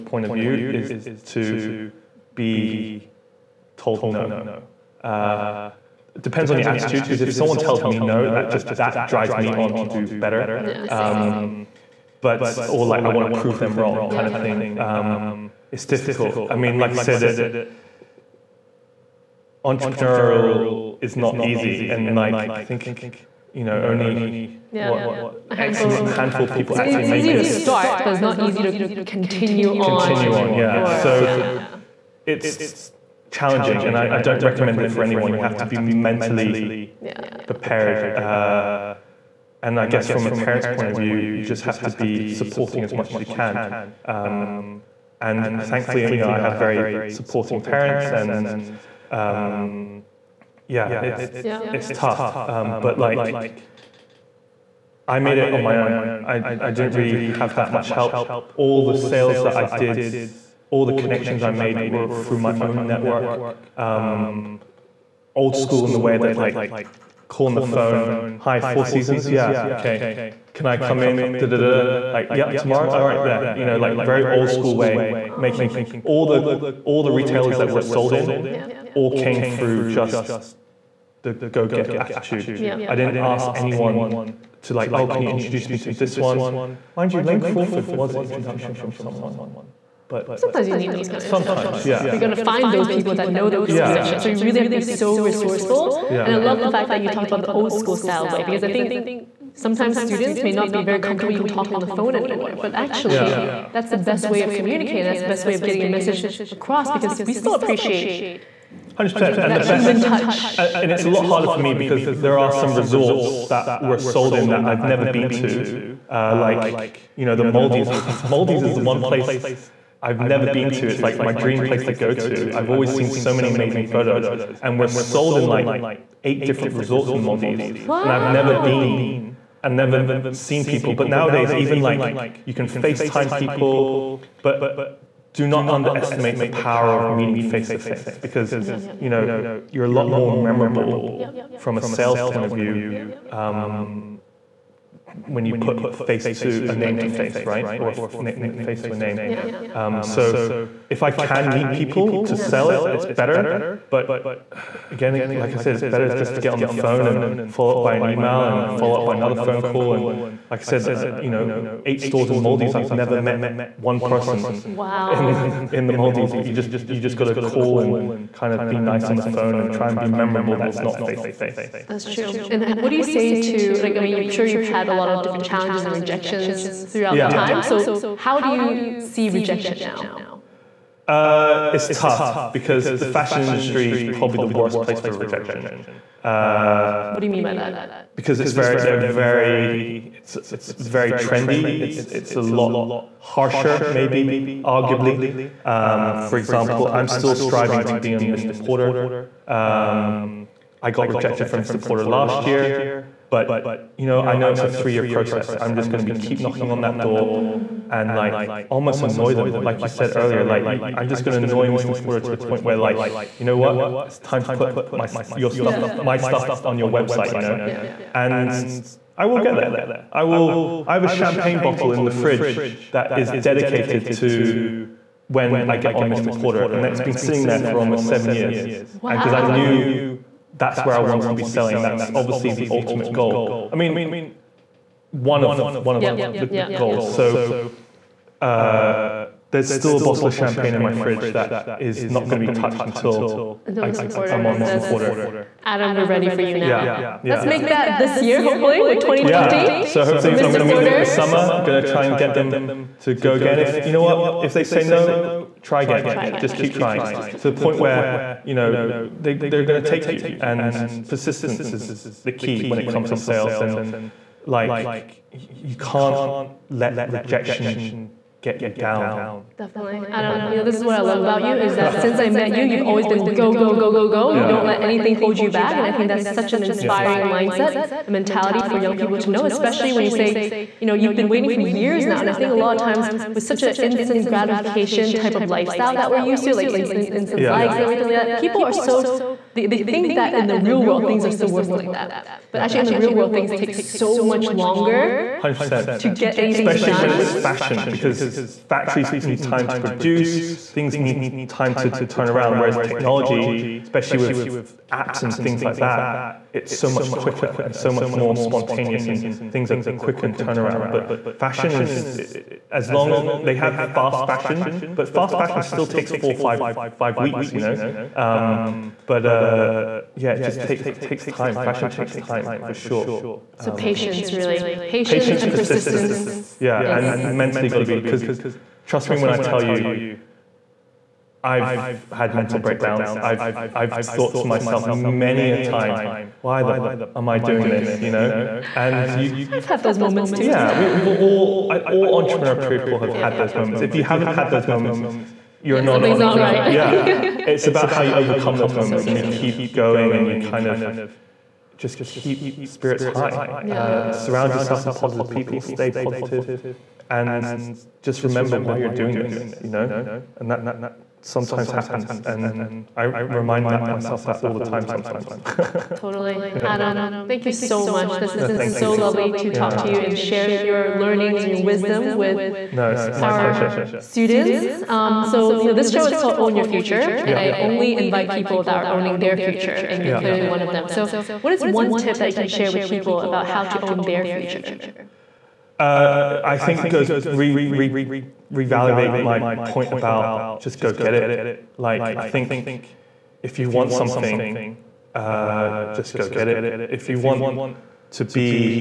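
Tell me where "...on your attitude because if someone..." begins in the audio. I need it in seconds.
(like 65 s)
6 s.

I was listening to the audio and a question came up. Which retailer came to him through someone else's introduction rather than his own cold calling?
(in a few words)
Lane Crawford.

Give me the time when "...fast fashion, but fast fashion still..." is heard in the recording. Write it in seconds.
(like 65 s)
313 s.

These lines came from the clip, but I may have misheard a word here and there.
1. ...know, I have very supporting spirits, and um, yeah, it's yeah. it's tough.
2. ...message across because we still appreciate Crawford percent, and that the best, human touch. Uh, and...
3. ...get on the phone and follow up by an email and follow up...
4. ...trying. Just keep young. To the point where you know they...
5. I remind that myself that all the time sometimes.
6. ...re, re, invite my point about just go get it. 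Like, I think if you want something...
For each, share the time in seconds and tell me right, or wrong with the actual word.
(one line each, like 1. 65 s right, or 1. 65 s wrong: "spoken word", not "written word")
1. 46 s wrong: "parents", not "spirits"
2. 105 s wrong: "Hundred", not "Crawford"
3. 156 s right
4. 256 s wrong: "trying", not "young"
5. 362 s right
6. 387 s wrong: "revalidate", not "invite".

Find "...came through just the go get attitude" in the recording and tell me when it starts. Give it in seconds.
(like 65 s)
79 s.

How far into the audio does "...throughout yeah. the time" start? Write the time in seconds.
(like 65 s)
176 s.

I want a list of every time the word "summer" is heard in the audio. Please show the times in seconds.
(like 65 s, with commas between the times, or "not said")
251 s.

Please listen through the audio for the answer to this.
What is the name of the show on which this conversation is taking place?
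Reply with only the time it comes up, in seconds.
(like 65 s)
376 s.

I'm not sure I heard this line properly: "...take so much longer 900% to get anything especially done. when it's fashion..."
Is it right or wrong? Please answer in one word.
wrong.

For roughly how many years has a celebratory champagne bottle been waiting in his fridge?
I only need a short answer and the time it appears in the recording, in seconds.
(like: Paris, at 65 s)
7, at 228 s.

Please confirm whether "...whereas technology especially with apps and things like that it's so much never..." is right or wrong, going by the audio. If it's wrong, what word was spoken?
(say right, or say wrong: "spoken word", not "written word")
wrong: "quicker", not "never".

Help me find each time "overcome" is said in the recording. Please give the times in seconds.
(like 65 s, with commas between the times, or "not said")
348 s.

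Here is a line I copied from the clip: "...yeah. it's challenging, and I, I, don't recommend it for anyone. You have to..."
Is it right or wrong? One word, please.
right.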